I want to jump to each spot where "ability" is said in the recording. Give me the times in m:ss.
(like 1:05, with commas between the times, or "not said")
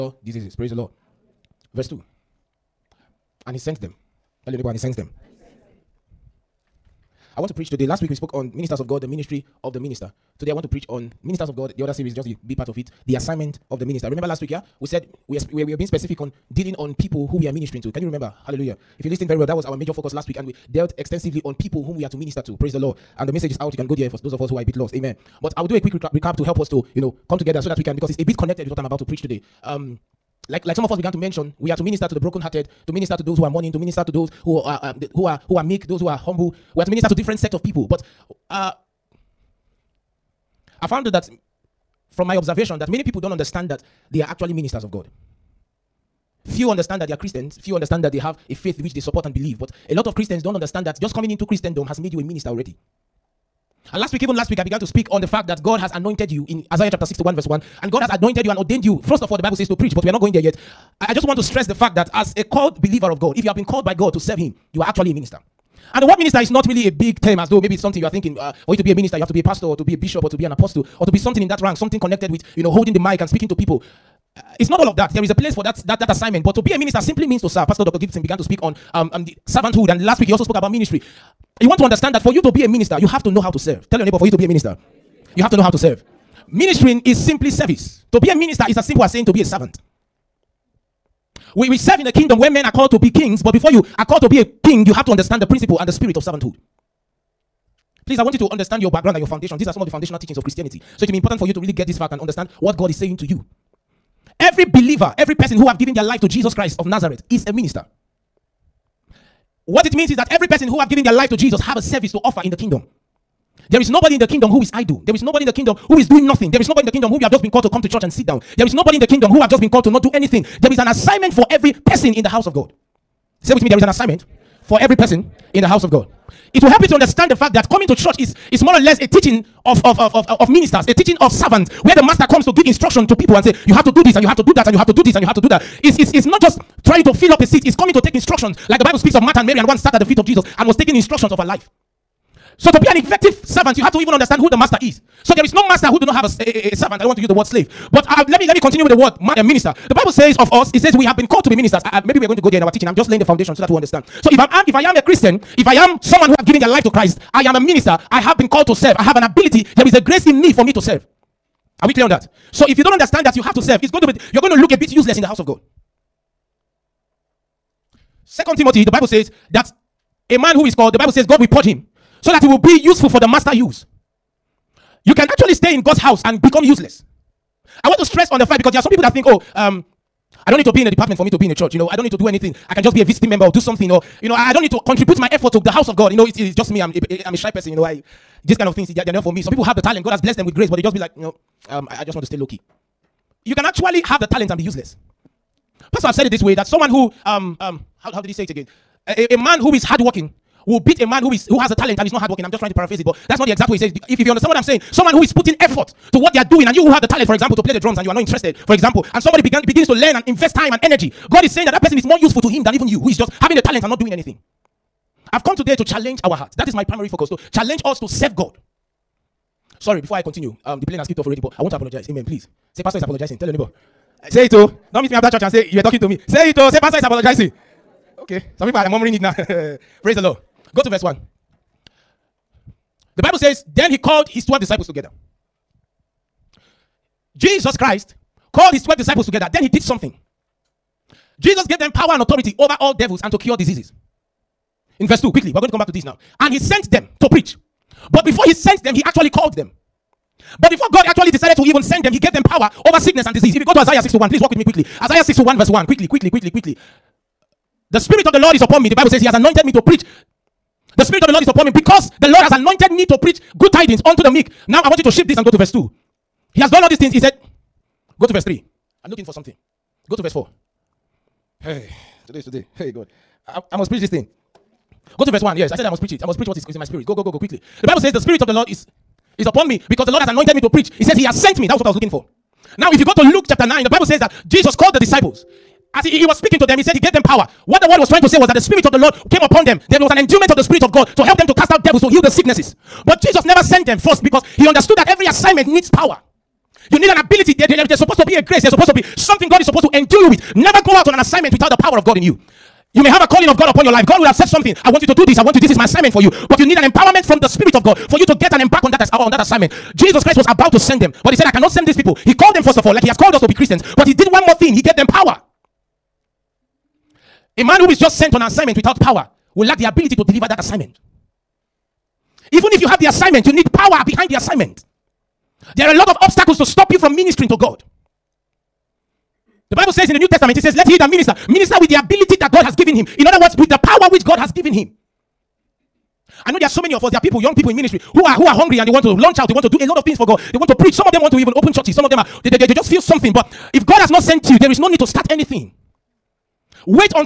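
2:39, 4:57, 5:19, 5:31.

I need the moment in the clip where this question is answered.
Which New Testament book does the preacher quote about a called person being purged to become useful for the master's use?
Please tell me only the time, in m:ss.
2:48.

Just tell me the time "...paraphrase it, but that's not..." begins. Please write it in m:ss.
3:22.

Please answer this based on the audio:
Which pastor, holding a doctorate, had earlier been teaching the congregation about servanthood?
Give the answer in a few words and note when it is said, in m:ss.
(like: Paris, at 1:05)
Pastor Dr. Gibson, at 1:17.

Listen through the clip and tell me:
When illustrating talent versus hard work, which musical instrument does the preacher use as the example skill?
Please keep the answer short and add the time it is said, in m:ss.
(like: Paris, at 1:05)
Drums, at 3:27.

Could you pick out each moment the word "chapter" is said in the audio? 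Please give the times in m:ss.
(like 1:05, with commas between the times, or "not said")
0:56, 4:43.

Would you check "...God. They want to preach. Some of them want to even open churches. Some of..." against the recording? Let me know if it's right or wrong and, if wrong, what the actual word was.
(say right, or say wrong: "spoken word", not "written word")
right.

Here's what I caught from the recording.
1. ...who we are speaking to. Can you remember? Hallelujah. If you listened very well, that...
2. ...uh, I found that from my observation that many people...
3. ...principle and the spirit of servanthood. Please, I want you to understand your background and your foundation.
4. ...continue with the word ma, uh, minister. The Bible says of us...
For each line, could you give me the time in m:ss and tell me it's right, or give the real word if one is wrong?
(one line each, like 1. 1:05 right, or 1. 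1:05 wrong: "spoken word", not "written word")
1. 0:17 wrong: "ministering", not "speaking"
2. 0:38 right
3. 1:35 right
4. 2:28 right.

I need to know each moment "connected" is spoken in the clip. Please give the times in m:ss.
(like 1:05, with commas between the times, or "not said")
0:28, 1:11.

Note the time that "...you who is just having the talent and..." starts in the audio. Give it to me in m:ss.
3:32.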